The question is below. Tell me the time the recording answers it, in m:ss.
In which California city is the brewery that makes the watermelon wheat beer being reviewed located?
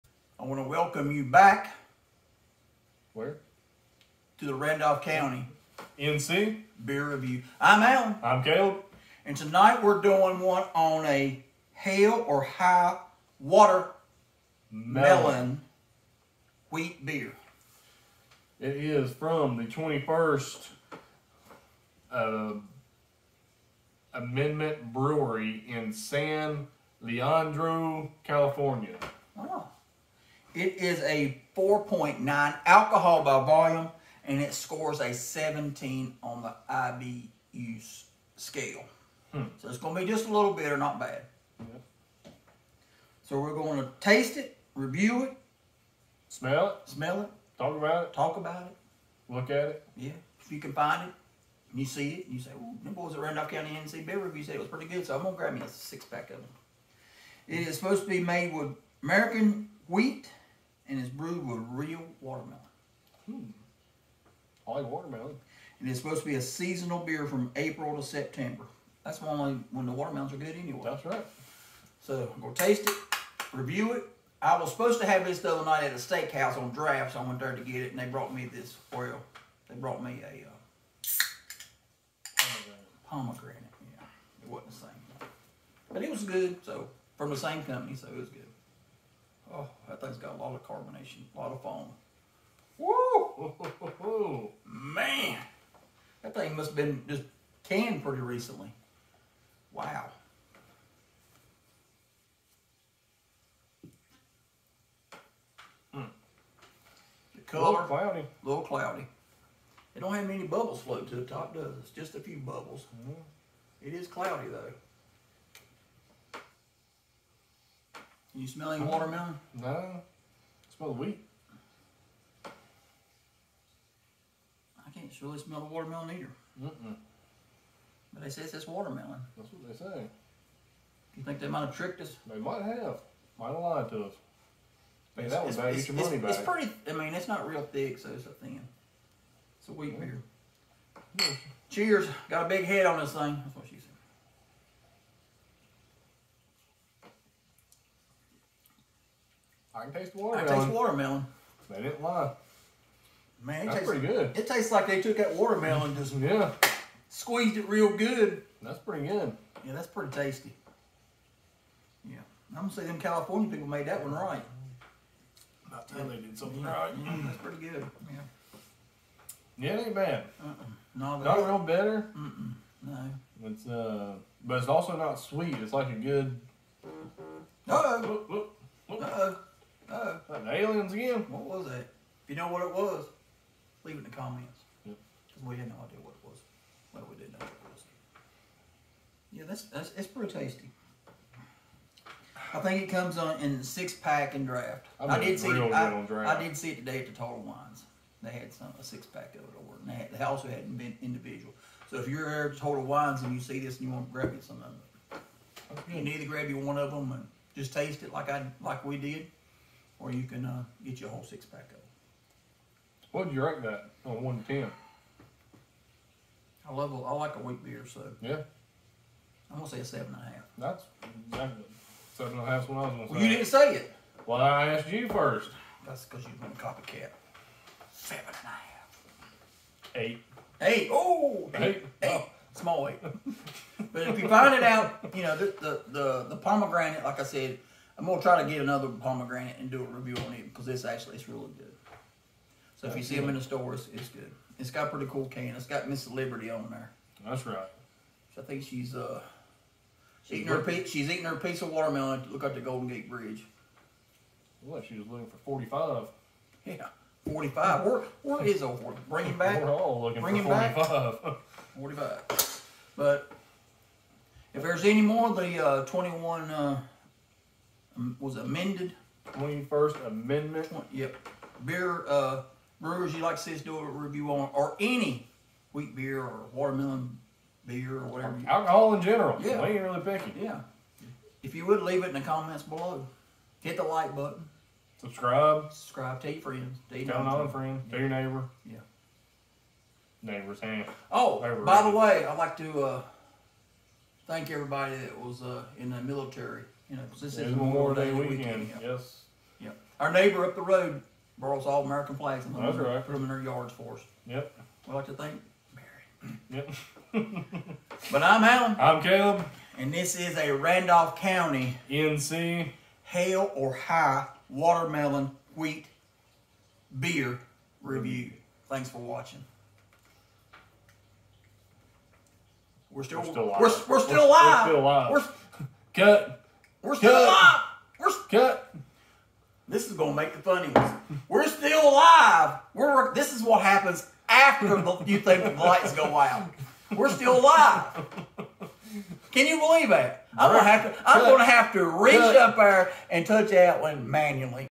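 0:25.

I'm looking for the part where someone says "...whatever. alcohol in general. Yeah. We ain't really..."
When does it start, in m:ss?
4:38.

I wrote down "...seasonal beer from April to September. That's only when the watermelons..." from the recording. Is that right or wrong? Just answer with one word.
right.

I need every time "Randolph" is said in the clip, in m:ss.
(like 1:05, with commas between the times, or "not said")
0:04, 0:53, 5:10.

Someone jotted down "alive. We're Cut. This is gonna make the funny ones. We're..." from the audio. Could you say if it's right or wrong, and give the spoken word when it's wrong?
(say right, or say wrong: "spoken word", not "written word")
right.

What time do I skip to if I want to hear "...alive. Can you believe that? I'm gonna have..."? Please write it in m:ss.
5:37.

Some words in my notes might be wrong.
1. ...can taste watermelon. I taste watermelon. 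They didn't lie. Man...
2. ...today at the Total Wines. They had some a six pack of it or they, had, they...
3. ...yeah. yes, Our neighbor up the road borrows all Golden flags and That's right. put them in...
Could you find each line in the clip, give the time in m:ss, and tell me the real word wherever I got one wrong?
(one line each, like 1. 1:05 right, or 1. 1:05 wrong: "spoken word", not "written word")
1. 2:29 right
2. 3:16 right
3. 4:58 wrong: "American", not "Golden".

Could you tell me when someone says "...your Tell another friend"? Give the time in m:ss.
4:46.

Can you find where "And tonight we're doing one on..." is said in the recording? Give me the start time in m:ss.
0:09.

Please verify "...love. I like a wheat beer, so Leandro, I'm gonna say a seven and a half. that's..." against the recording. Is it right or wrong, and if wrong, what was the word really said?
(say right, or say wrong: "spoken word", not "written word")
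wrong: "Yeah", not "Leandro".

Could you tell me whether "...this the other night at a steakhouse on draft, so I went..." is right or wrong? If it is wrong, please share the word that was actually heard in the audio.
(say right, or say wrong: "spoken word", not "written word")
right.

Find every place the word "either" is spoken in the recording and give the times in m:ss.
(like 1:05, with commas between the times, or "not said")
2:06, 3:26.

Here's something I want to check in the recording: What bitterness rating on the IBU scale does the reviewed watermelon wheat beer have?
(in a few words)
17.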